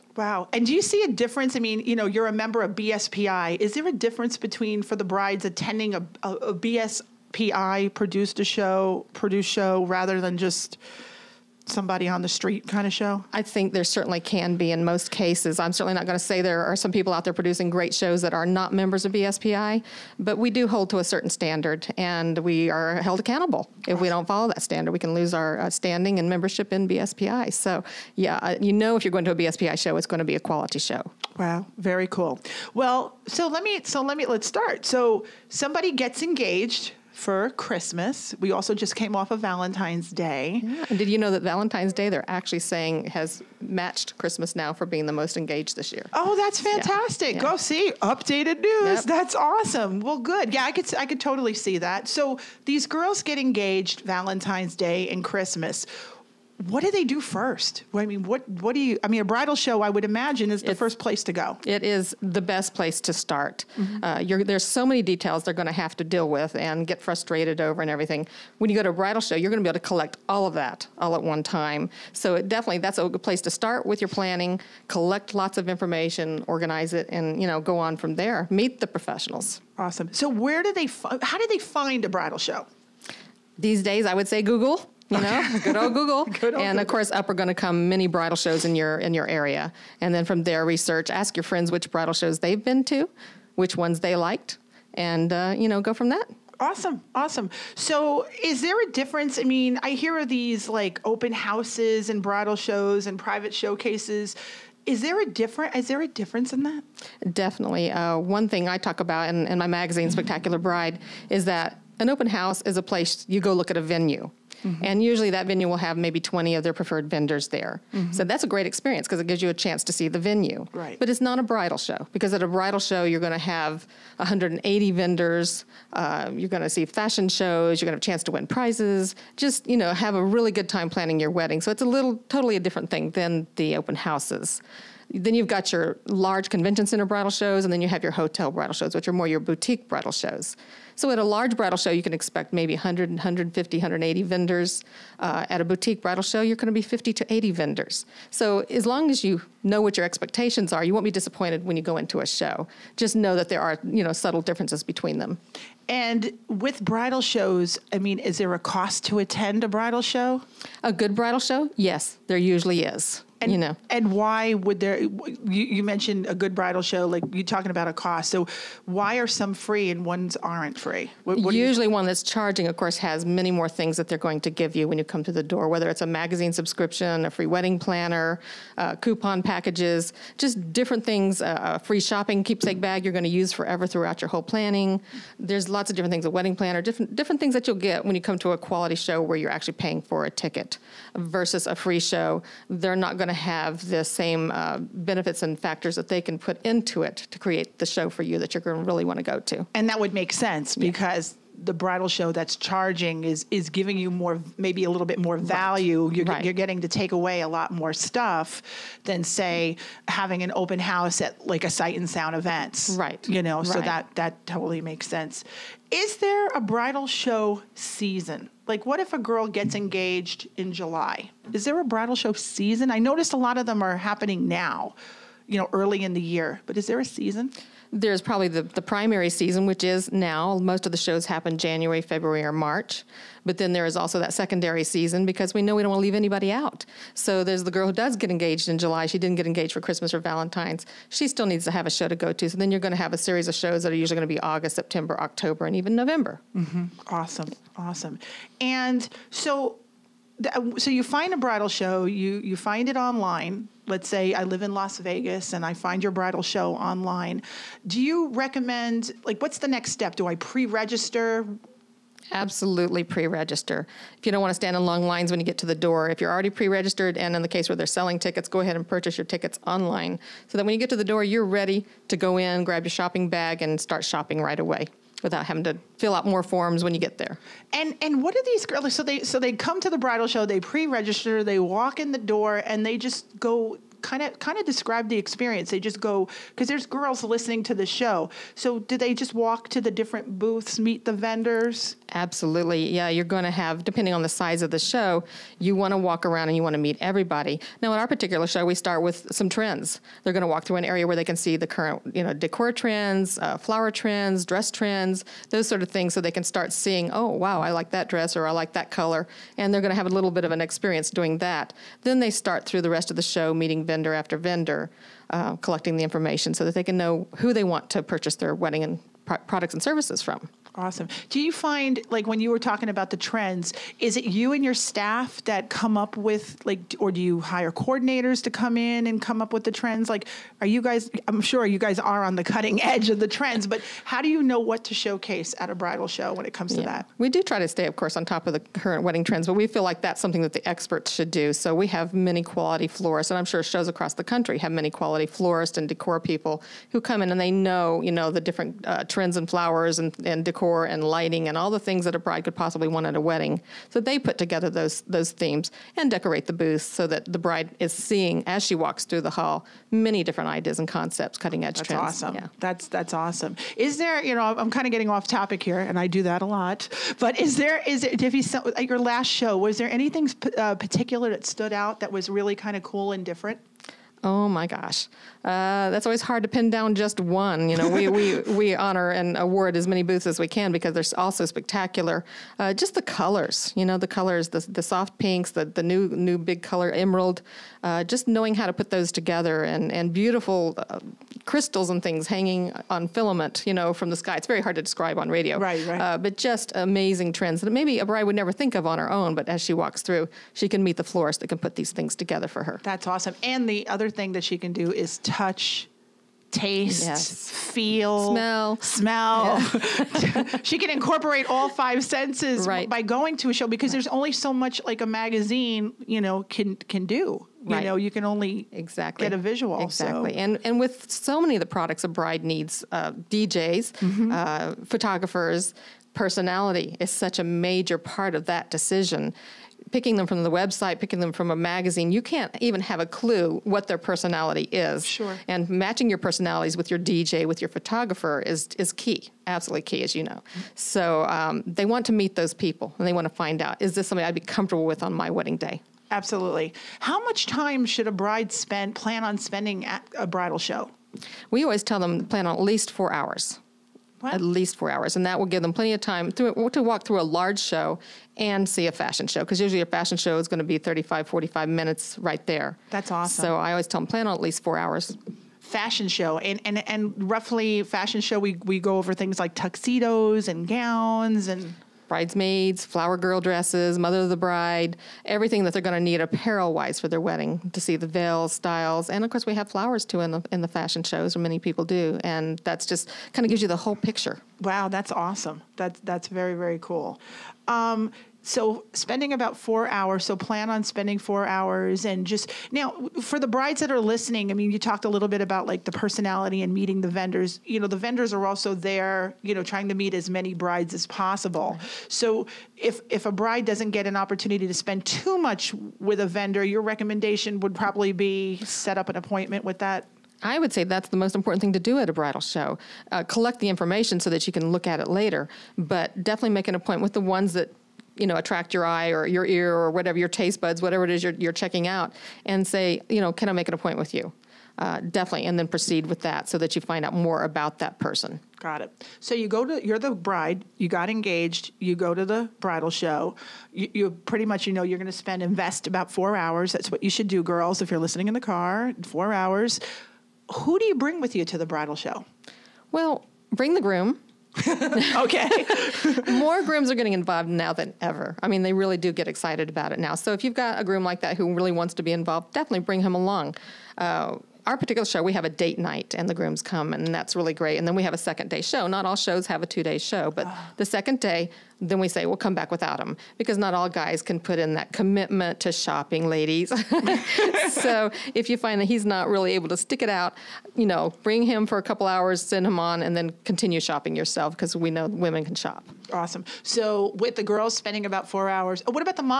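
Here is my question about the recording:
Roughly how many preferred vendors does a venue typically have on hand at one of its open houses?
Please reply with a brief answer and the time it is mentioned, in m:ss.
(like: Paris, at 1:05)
20, at 1:56.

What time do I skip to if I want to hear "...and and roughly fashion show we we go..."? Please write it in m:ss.
7:46.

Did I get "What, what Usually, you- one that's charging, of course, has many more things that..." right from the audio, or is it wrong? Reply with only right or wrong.
right.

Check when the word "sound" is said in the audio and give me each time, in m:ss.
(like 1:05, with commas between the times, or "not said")
3:32.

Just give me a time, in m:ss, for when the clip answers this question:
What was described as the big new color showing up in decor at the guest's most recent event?
6:26.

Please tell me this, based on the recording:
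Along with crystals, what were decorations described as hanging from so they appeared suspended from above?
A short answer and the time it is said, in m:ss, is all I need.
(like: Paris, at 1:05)
filament, at 6:33.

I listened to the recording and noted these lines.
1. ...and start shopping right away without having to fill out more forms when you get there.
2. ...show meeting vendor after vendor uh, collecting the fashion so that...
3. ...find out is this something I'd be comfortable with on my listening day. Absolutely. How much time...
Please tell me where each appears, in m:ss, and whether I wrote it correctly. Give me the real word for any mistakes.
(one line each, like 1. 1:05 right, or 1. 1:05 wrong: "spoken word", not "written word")
1. 4:33 right
2. 5:13 wrong: "information", not "fashion"
3. 7:23 wrong: "wedding", not "listening".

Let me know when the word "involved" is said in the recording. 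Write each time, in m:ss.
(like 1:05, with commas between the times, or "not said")
9:07, 9:12.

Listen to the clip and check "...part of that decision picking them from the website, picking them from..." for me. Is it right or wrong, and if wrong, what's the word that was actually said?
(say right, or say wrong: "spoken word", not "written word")
right.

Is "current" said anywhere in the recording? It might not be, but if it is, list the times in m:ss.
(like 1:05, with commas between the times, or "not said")
5:01, 5:38.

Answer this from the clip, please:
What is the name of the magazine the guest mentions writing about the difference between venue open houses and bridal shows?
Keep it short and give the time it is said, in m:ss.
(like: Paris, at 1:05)
Spectacular Bride, at 1:50.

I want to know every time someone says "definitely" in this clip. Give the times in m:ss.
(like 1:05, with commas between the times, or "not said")
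1:12, 1:47, 8:36, 8:45, 9:12.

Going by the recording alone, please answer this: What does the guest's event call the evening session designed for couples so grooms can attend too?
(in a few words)
date night.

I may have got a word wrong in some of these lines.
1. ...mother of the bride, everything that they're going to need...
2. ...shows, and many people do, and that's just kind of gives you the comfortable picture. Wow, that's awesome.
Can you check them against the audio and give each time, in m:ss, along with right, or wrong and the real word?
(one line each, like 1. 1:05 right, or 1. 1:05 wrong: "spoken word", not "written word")
1. 7:53 right
2. 8:01 wrong: "whole", not "comfortable".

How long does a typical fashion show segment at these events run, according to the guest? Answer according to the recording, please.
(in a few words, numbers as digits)
35 to 45 minutes.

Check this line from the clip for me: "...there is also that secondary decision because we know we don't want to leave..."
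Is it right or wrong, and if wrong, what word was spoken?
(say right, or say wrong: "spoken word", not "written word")
wrong: "season", not "decision".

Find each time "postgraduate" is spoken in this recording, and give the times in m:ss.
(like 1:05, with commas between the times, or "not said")
not said.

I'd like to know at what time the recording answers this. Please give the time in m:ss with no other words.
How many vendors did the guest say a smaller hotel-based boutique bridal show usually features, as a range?
2:26.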